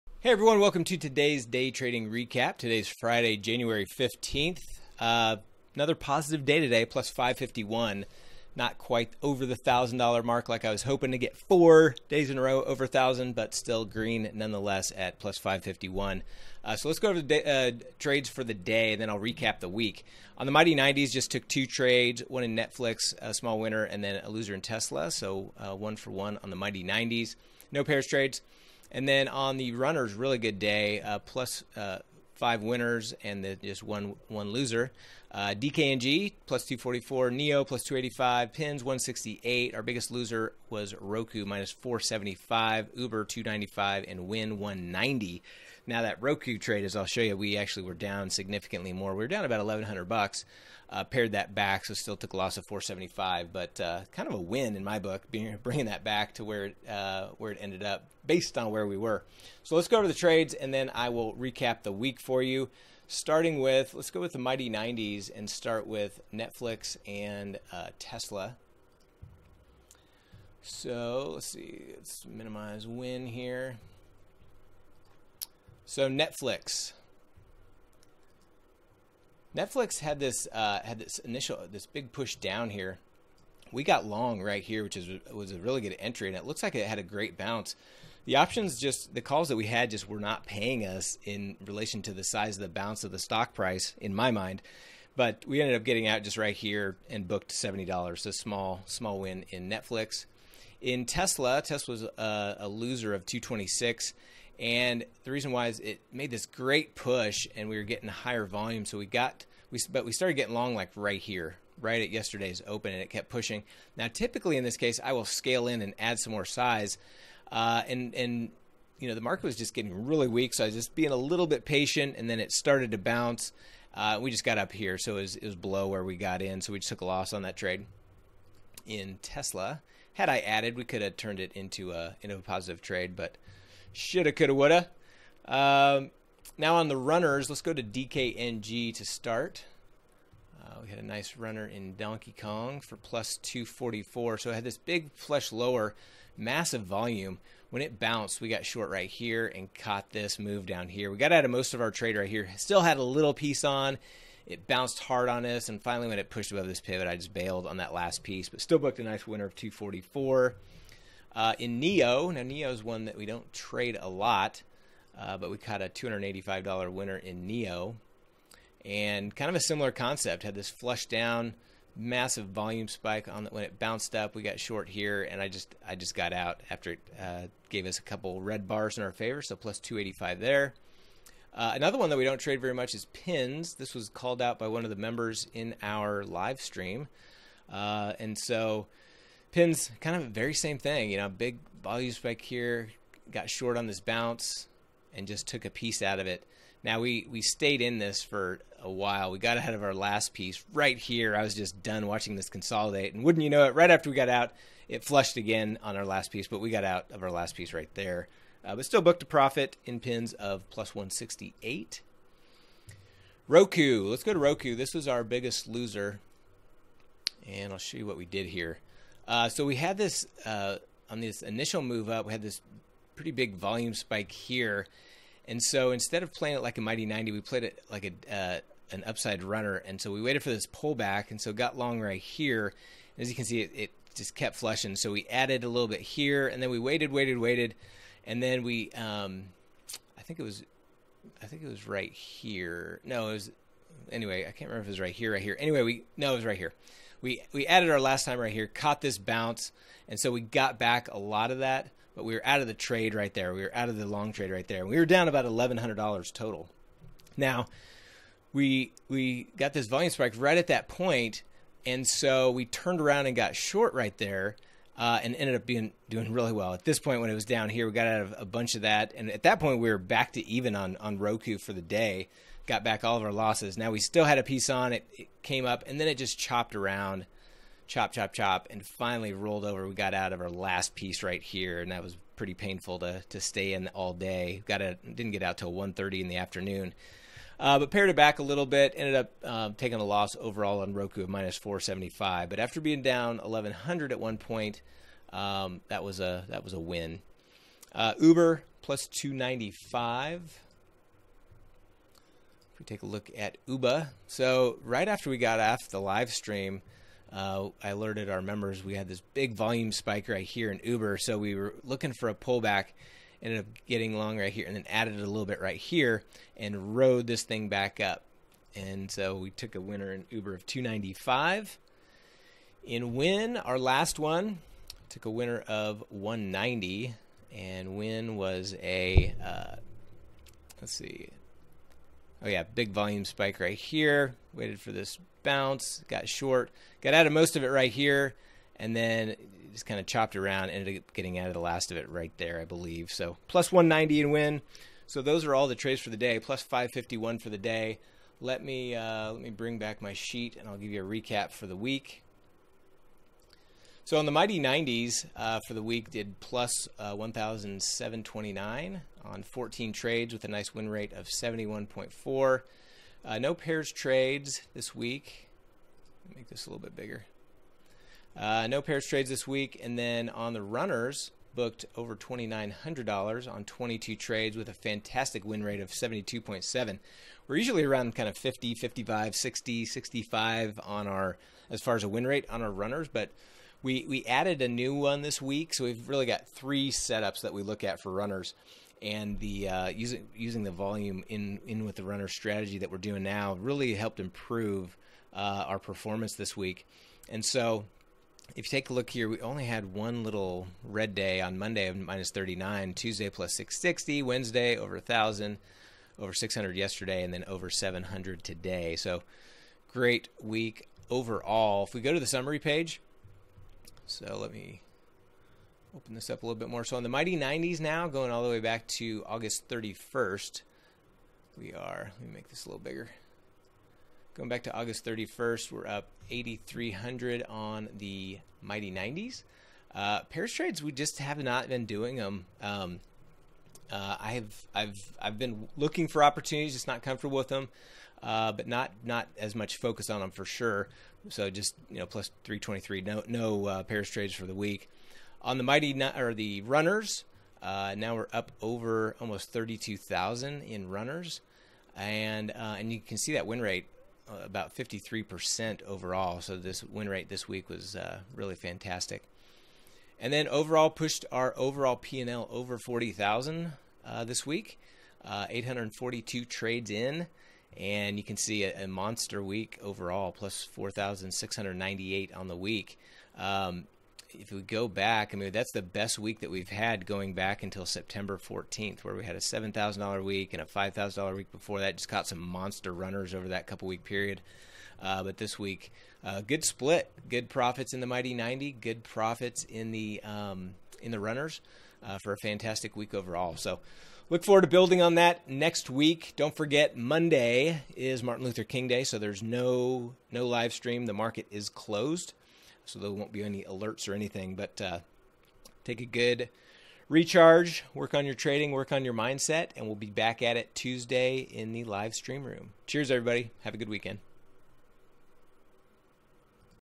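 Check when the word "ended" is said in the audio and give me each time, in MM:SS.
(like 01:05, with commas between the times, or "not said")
00:57, 01:35, 04:25, 04:48, 05:13, 05:40.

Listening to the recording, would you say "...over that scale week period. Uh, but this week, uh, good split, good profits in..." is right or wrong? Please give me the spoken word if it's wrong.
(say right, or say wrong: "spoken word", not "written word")
wrong: "couple", not "scale".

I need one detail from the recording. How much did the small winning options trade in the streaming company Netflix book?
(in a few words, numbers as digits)
$70.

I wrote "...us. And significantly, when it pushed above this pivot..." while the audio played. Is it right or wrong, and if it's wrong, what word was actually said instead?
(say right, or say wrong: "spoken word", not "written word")
wrong: "finally", not "significantly".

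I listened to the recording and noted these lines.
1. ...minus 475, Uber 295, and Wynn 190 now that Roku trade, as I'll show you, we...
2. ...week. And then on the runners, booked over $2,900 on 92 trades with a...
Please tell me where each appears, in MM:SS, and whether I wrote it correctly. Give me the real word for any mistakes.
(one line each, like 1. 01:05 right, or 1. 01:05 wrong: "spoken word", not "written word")
1. 00:41 right
2. 06:09 wrong: "22", not "92".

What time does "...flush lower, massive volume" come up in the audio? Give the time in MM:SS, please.
02:25.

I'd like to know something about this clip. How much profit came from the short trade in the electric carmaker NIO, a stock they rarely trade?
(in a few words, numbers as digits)
$285.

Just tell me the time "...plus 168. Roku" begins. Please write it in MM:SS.
03:30.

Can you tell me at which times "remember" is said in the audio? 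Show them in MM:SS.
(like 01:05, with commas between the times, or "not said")
04:04.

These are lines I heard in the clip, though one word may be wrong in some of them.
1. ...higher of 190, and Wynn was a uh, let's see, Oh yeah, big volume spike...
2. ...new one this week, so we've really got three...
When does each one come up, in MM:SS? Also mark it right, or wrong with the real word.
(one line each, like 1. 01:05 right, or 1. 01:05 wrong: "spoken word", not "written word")
1. 05:25 wrong: "winner", not "higher"
2. 06:24 right.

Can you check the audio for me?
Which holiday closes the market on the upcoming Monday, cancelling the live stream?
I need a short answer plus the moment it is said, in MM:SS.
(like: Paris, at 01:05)
Martin Luther King Day, at 08:18.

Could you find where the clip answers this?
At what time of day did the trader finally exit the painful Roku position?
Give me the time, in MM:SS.
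04:45.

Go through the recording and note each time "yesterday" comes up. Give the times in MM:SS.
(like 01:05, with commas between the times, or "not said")
01:52, 06:46.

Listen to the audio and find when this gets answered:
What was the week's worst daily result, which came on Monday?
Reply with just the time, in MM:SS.
06:41.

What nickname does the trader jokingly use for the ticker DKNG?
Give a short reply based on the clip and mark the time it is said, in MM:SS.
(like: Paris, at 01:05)
Donkey Kong, at 02:21.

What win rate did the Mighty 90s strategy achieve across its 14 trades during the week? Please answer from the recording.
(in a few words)
71.4.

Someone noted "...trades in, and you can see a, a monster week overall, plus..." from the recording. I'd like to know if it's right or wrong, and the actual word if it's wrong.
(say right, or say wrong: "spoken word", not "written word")
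right.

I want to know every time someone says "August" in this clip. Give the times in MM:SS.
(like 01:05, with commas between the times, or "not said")
06:59, 07:04.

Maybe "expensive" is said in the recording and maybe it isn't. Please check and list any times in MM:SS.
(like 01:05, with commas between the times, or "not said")
not said.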